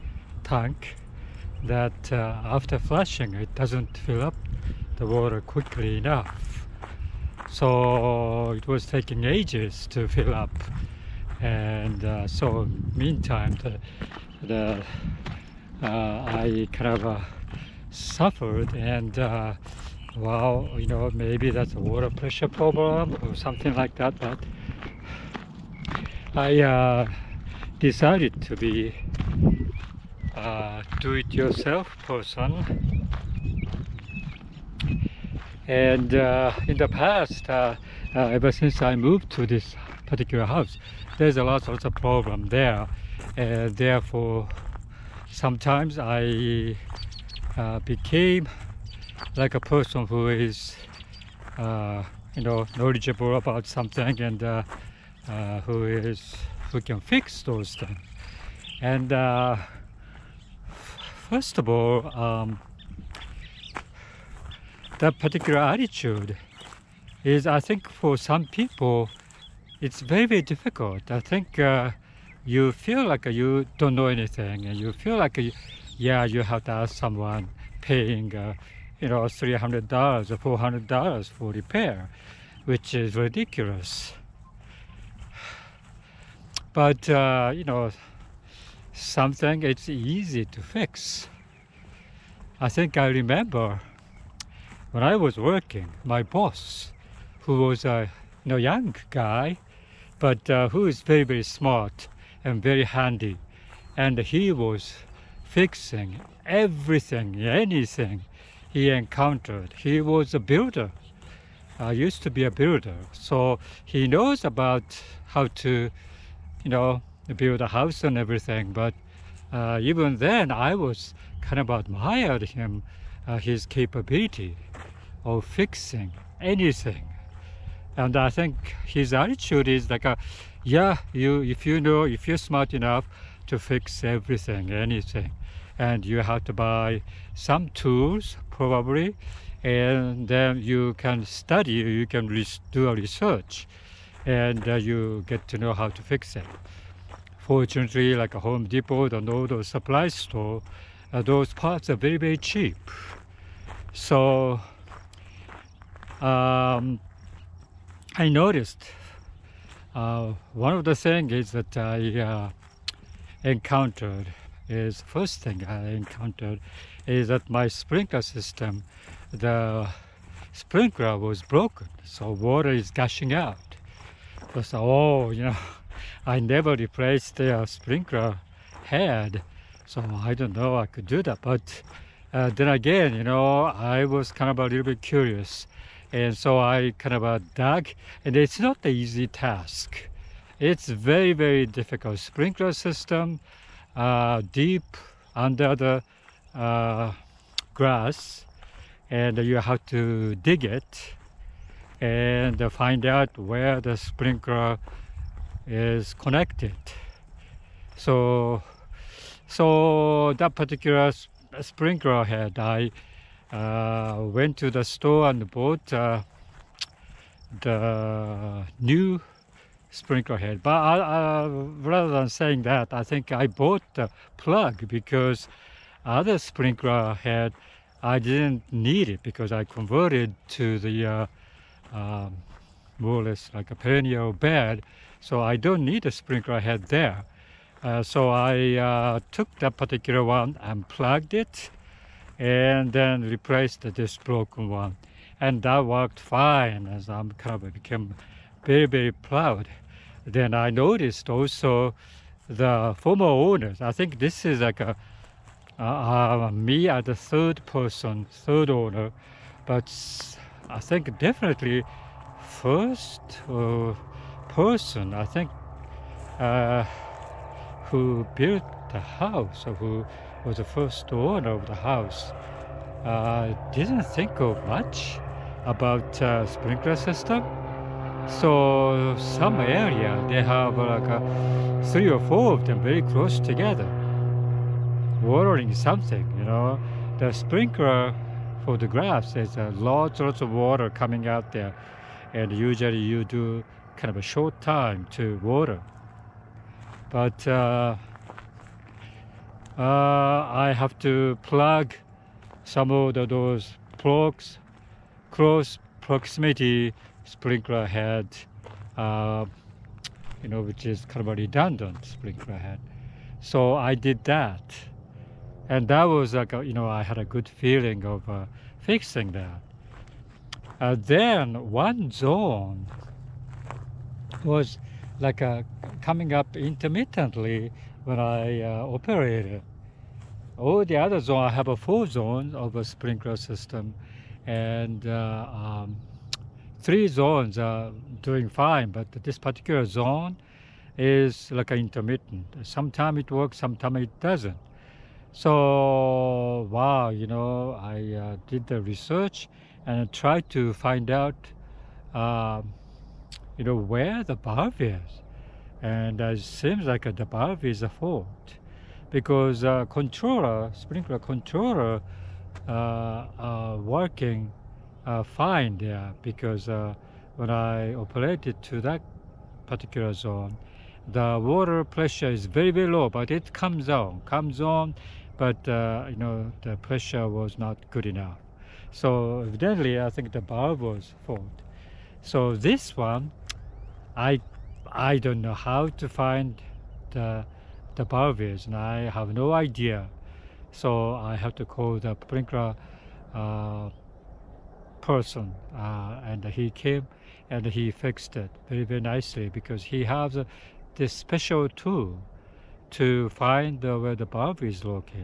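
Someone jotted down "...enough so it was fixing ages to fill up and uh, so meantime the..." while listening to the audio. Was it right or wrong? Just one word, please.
wrong.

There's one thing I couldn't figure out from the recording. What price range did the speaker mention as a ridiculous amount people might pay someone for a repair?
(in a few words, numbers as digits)
$300 or $400.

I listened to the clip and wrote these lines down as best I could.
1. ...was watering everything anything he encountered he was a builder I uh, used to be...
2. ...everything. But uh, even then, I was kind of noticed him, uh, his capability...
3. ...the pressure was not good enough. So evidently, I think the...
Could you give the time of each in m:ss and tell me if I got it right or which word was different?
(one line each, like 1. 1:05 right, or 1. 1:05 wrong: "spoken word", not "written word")
1. 1:44 wrong: "fixing", not "watering"
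2. 1:58 wrong: "admired", not "noticed"
3. 6:16 right.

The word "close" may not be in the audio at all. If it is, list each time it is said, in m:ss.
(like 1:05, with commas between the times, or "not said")
4:43, 5:05.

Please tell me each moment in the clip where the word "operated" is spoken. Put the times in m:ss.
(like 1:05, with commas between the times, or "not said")
5:28, 6:07.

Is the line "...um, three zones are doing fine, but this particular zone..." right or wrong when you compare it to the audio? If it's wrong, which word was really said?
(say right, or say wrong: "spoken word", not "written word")
right.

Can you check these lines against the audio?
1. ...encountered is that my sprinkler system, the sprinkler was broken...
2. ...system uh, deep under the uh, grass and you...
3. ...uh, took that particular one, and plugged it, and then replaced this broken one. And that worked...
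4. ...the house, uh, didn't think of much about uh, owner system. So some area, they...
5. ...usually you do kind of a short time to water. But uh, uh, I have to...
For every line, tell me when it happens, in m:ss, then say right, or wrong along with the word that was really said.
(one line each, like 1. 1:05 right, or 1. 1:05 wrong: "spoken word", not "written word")
1. 2:45 right
2. 3:12 right
3. 3:58 right
4. 4:31 wrong: "sprinkler", not "owner"
5. 4:52 right.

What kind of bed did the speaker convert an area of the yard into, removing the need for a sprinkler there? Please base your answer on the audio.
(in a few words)
Perennial bed.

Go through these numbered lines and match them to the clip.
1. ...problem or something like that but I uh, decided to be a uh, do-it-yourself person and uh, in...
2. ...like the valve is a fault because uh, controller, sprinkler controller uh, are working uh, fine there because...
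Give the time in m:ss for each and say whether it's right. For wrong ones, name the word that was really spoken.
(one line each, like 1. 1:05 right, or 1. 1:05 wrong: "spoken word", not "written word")
1. 0:22 right
2. 5:56 right.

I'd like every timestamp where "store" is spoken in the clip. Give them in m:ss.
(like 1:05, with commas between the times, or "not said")
2:30, 3:34.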